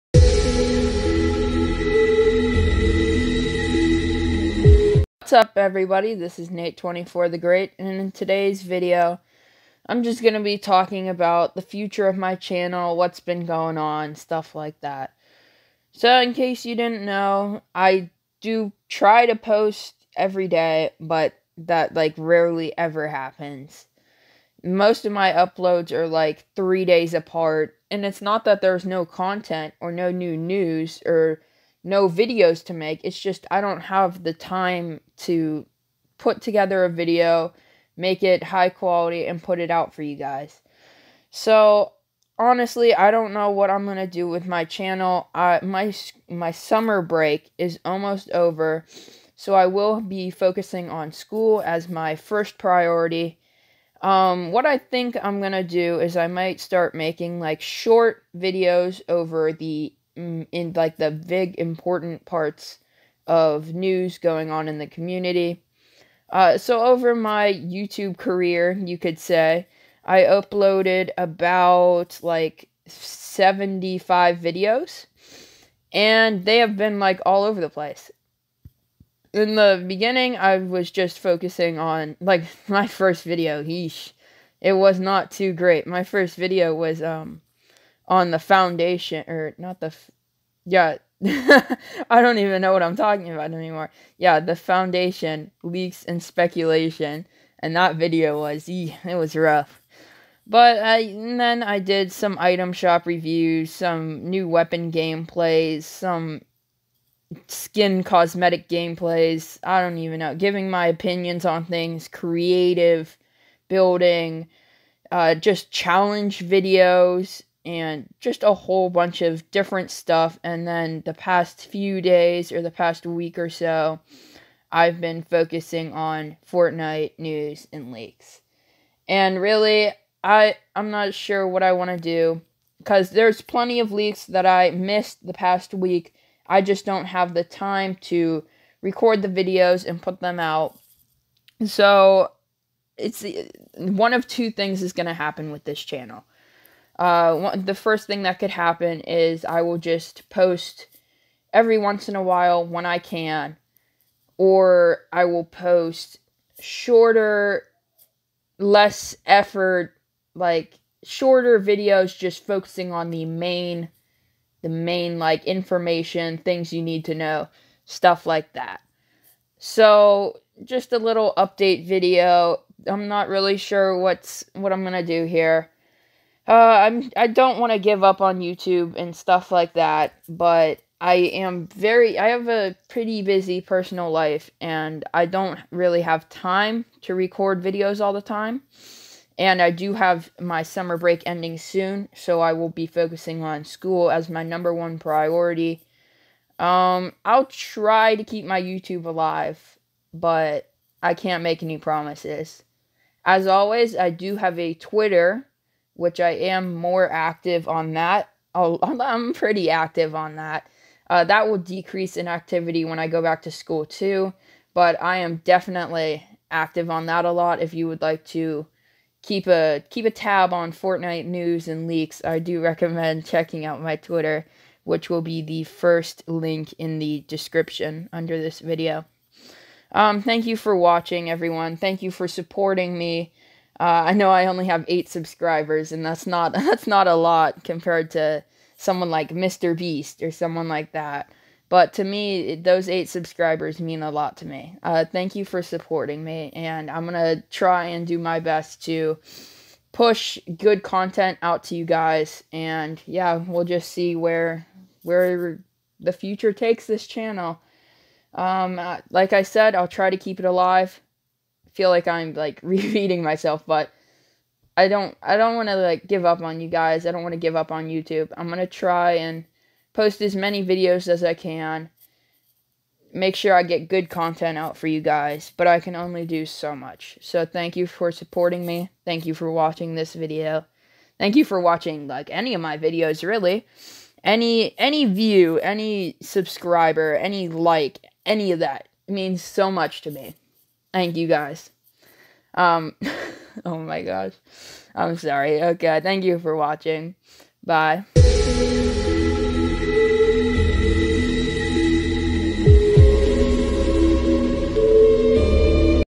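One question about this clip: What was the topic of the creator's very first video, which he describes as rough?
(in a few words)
Foundation leaks and speculation.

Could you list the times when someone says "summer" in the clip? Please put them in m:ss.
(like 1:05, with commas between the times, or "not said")
0:46, 3:10.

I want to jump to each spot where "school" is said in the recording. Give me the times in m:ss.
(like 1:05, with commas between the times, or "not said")
0:51, 3:13, 3:33.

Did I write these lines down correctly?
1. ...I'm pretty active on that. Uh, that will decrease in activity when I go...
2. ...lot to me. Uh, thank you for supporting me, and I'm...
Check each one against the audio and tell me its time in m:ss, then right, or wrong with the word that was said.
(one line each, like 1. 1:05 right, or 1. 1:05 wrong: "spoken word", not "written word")
1. 3:28 right
2. 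4:04 right.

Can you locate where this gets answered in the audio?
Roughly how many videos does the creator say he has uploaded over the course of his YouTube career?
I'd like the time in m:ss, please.
1:12.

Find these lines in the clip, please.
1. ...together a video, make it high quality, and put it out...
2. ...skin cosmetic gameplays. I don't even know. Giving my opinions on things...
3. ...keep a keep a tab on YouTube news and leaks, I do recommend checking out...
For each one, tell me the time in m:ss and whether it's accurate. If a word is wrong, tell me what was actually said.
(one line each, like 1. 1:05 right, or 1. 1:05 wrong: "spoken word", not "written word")
1. 0:36 right
2. 1:47 right
3. 3:39 wrong: "Fortnite", not "YouTube".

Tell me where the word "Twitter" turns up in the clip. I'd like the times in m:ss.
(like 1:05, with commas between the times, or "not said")
3:24, 3:43.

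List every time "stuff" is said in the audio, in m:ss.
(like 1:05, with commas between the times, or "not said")
0:14, 1:59, 2:47, 2:59.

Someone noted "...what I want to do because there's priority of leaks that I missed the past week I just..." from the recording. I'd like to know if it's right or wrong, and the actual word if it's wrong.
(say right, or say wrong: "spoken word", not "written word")
wrong: "plenty", not "priority".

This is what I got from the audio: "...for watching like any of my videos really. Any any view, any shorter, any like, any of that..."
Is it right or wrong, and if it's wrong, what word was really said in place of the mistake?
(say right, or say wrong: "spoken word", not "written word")
wrong: "subscriber", not "shorter".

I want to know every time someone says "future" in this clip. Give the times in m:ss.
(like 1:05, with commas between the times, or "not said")
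0:11, 4:16.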